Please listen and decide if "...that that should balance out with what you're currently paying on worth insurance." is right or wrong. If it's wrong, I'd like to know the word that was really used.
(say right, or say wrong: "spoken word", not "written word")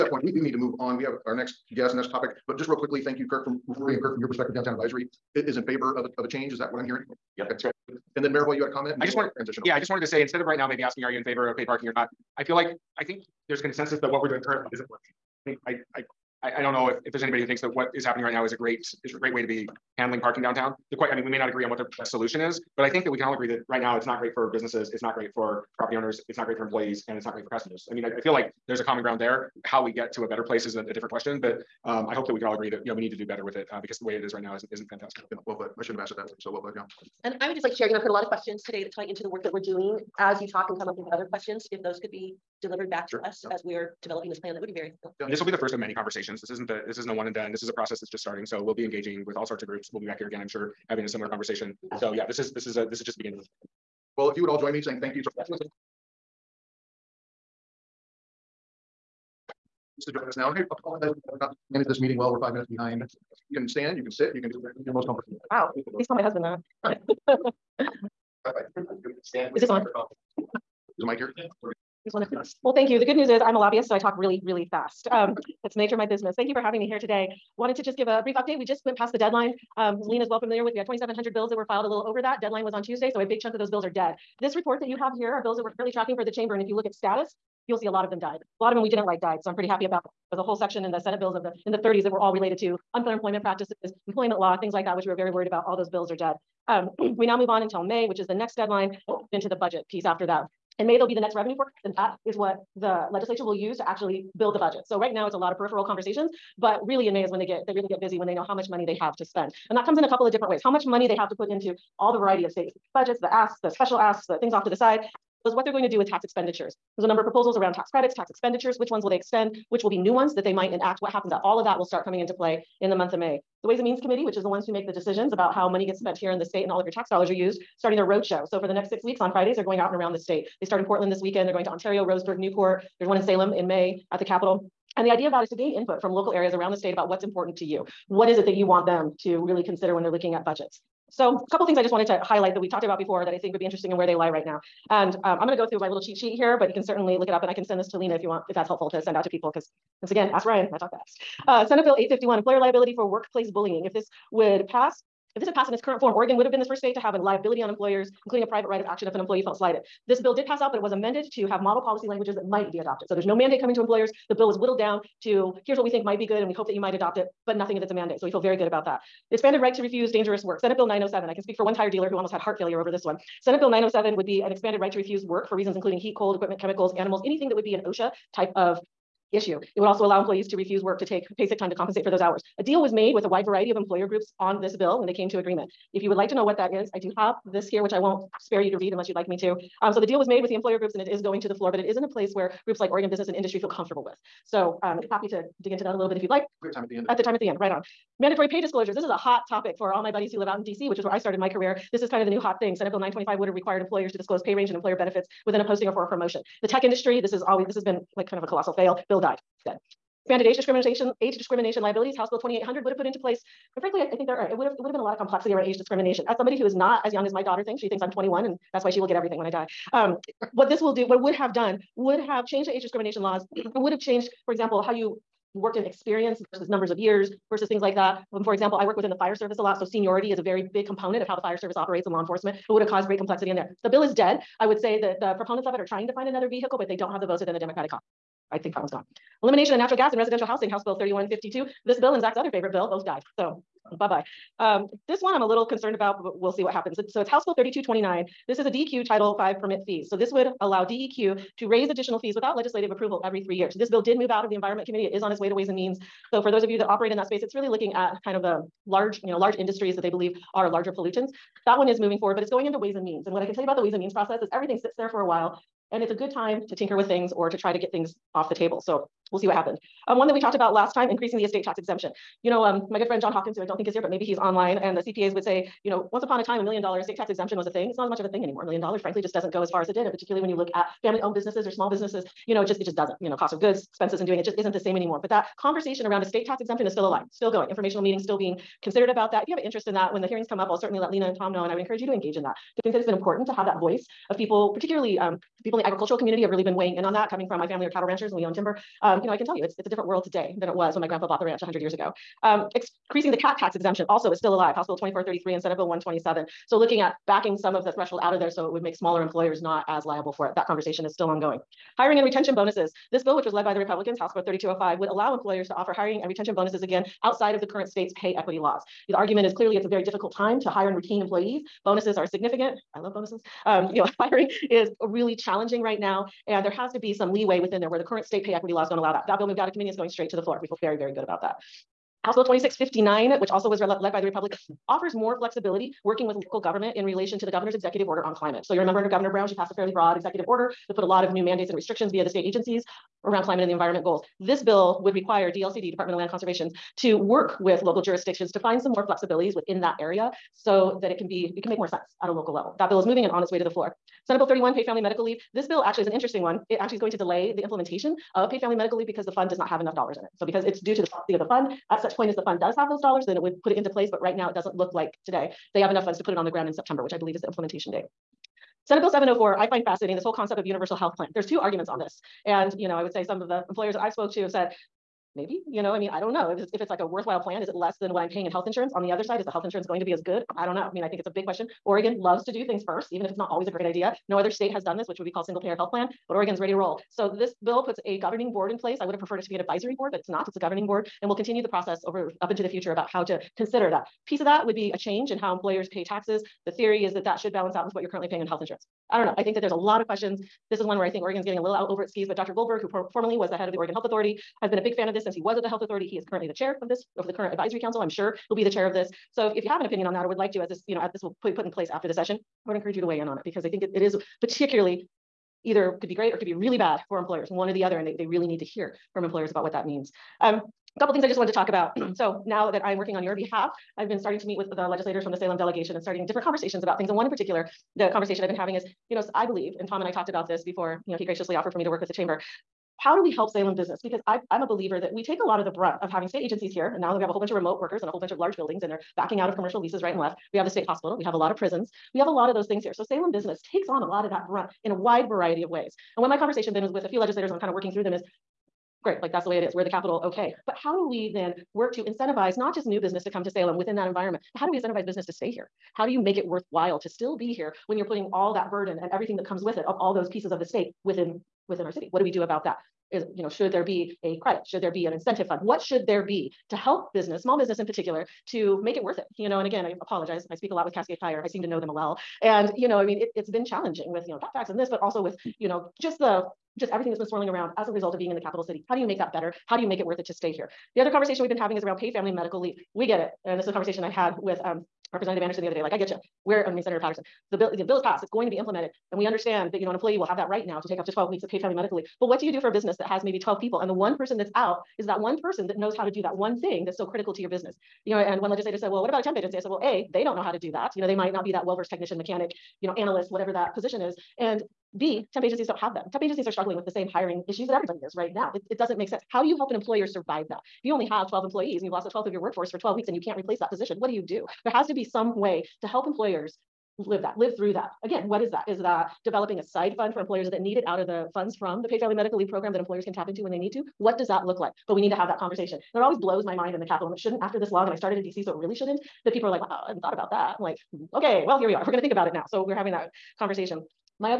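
wrong: "health", not "worth".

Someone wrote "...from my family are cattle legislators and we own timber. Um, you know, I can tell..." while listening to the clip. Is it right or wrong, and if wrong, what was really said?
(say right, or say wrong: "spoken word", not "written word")
wrong: "ranchers", not "legislators".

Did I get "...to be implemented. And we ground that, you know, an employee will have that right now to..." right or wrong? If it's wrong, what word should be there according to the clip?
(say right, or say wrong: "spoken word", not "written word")
wrong: "understand", not "ground".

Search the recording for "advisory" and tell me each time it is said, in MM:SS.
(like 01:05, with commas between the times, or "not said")
00:04, 06:29, 06:47.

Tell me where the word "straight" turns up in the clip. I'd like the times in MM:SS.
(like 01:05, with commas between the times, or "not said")
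05:30.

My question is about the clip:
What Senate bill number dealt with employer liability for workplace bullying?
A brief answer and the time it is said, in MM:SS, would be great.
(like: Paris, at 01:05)
851, at 02:31.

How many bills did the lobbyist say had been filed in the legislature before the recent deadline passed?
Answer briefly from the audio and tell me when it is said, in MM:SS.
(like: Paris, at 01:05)
2,700, at 01:20.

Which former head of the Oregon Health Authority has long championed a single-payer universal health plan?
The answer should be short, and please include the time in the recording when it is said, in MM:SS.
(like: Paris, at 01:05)
Dr. Goldberg, at 06:42.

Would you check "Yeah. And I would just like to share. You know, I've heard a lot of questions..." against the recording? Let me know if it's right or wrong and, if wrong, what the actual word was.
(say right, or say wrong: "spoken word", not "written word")
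right.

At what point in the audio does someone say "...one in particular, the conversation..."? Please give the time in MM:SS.
07:07.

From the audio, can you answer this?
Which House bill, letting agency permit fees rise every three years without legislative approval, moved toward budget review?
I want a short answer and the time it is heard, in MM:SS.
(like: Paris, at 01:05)
3229, at 04:07.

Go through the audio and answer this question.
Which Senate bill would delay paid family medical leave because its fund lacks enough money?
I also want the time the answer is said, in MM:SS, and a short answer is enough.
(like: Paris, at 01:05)
31, at 05:54.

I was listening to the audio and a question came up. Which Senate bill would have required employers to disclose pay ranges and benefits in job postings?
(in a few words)
925.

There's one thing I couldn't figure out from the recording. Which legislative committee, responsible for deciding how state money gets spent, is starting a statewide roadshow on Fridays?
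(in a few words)
Ways and Means Committee.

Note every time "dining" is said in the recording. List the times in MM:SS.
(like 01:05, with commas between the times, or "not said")
not said.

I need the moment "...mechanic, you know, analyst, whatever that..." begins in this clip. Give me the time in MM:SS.
08:22.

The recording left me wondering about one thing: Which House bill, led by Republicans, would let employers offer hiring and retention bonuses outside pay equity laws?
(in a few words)
3205.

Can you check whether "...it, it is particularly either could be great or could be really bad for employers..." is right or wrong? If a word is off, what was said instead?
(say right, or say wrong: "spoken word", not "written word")
right.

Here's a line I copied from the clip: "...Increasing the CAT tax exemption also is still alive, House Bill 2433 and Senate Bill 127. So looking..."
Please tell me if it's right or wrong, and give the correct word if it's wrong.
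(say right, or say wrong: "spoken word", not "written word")
right.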